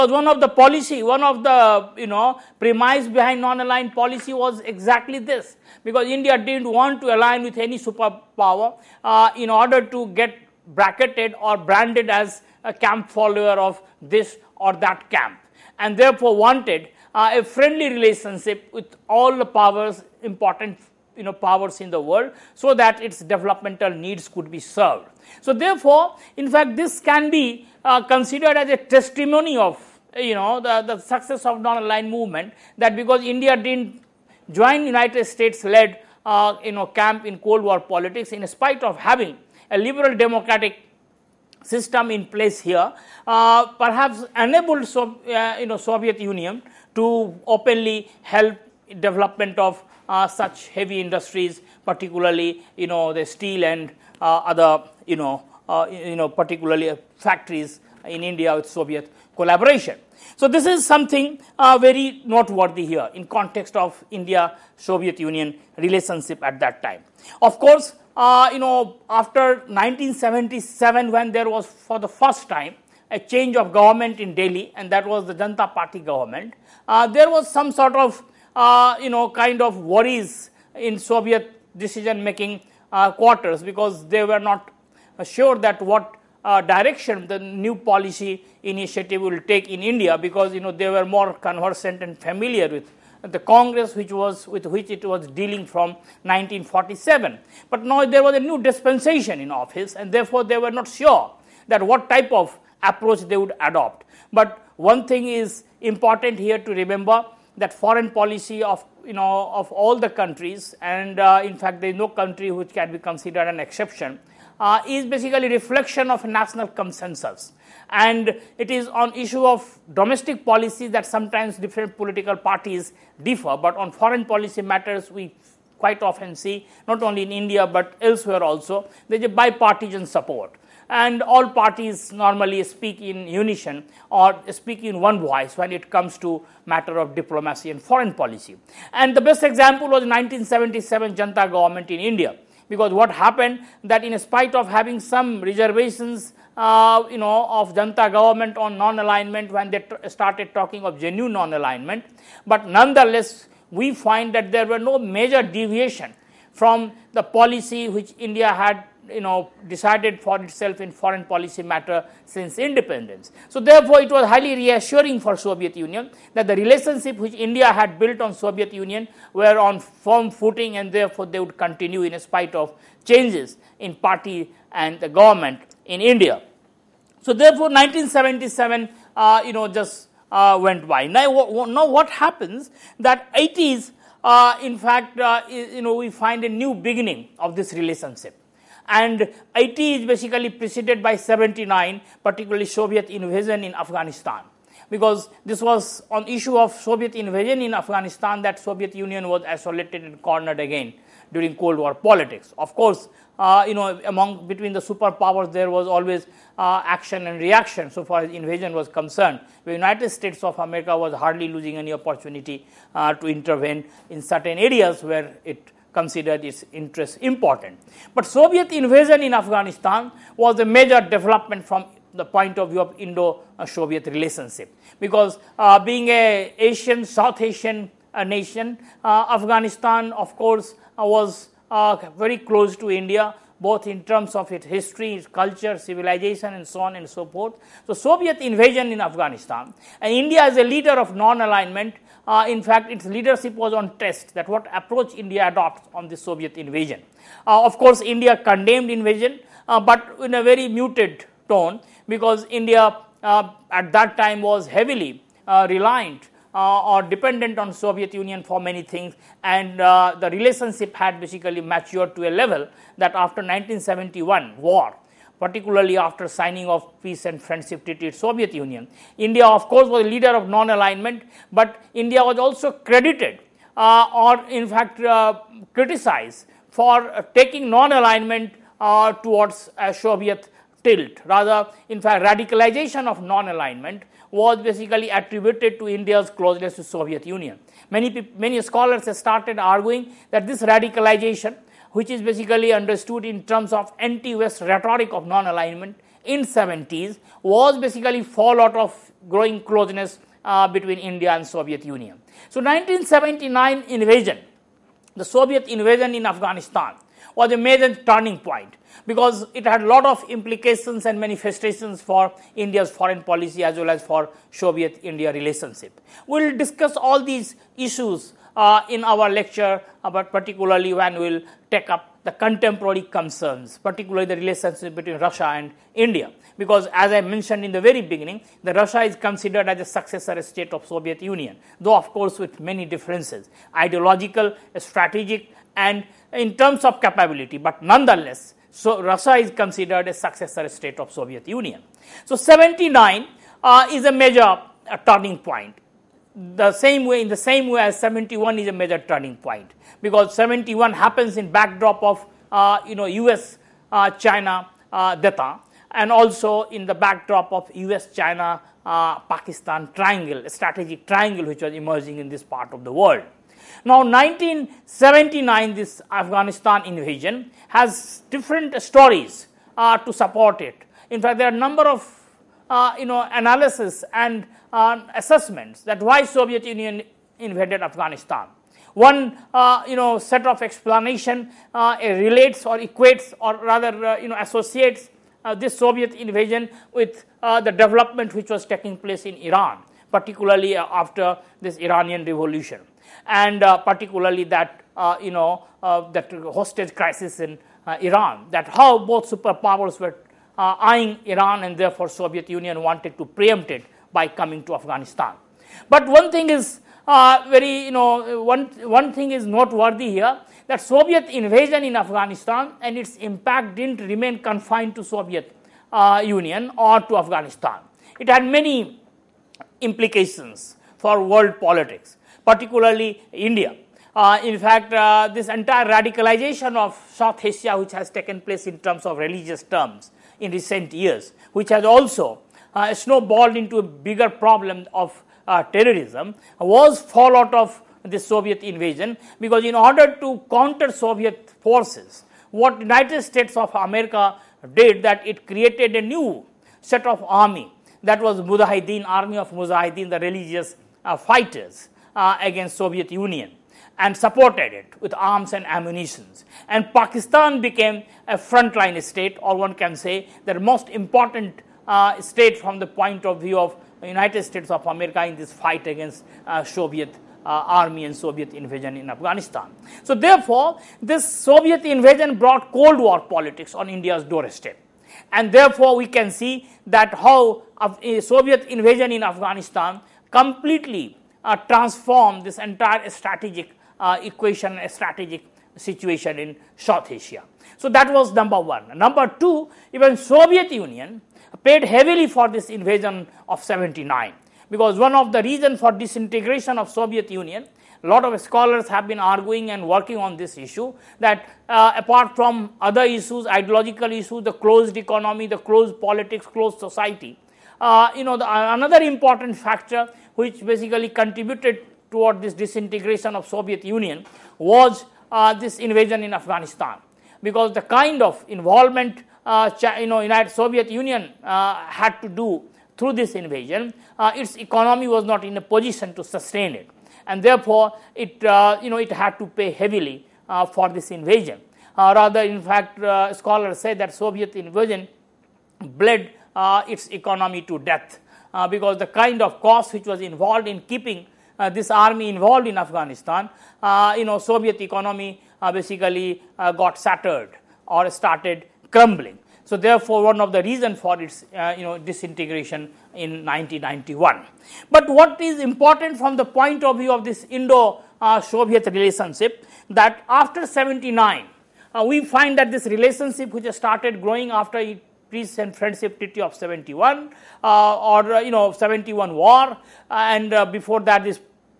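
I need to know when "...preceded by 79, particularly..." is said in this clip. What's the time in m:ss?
3:10.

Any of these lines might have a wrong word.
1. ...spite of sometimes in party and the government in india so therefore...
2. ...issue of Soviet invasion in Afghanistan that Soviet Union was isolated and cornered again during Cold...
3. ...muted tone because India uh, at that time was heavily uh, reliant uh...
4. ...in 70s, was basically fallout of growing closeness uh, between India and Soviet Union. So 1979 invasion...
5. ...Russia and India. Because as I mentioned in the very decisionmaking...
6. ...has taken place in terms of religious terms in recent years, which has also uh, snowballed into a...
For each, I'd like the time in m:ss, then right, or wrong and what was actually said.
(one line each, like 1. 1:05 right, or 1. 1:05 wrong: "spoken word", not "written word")
1. 2:52 wrong: "changes", not "sometimes"
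2. 3:16 right
3. 4:10 right
4. 4:56 right
5. 5:25 wrong: "beginning", not "decisionmaking"
6. 7:07 right.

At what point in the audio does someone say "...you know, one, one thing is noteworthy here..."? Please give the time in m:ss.
6:47.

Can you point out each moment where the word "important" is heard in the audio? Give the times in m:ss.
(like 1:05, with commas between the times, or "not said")
0:20, 1:45, 3:37, 7:40, 8:29, 9:15.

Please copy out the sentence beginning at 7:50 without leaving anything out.
So therefore, this Soviet invasion brought Cold War politics on India's doorstep.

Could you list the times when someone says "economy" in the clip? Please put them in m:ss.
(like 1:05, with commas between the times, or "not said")
8:24, 8:44, 8:57, 9:04.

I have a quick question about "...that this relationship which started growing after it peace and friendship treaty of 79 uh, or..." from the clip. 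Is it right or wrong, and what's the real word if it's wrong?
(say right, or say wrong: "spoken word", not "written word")
wrong: "71", not "79".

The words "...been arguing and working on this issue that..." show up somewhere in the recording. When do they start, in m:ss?
8:19.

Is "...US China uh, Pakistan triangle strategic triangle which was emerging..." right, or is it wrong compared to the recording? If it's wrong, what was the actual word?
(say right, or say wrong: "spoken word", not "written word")
right.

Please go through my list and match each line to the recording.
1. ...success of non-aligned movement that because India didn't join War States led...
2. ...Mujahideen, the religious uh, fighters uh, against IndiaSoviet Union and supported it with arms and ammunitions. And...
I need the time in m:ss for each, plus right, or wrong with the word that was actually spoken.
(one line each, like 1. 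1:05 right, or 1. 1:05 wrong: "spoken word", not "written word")
1. 0:30 wrong: "United", not "War"
2. 7:29 wrong: "Soviet", not "IndiaSoviet".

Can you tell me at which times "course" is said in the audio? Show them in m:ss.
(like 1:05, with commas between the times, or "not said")
1:07, 3:22, 3:50, 4:07, 4:29, 5:32.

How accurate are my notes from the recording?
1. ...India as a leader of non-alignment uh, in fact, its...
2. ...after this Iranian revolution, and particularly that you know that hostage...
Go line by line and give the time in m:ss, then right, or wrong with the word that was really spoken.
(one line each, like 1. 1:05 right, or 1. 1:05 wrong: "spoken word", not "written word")
1. 4:00 right
2. 6:30 right.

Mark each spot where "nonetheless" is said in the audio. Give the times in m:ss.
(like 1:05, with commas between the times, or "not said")
2:32, 5:37.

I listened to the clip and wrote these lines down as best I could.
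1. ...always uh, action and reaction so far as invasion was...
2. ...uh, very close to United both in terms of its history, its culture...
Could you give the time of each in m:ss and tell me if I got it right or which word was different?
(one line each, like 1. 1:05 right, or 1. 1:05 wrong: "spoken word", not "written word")
1. 3:25 right
2. 3:51 wrong: "India", not "United".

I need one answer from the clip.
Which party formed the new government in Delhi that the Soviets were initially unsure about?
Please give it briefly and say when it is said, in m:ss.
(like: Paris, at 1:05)
Janta Party, at 1:15.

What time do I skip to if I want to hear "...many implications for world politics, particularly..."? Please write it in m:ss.
6:58.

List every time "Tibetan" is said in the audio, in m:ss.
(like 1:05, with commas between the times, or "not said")
not said.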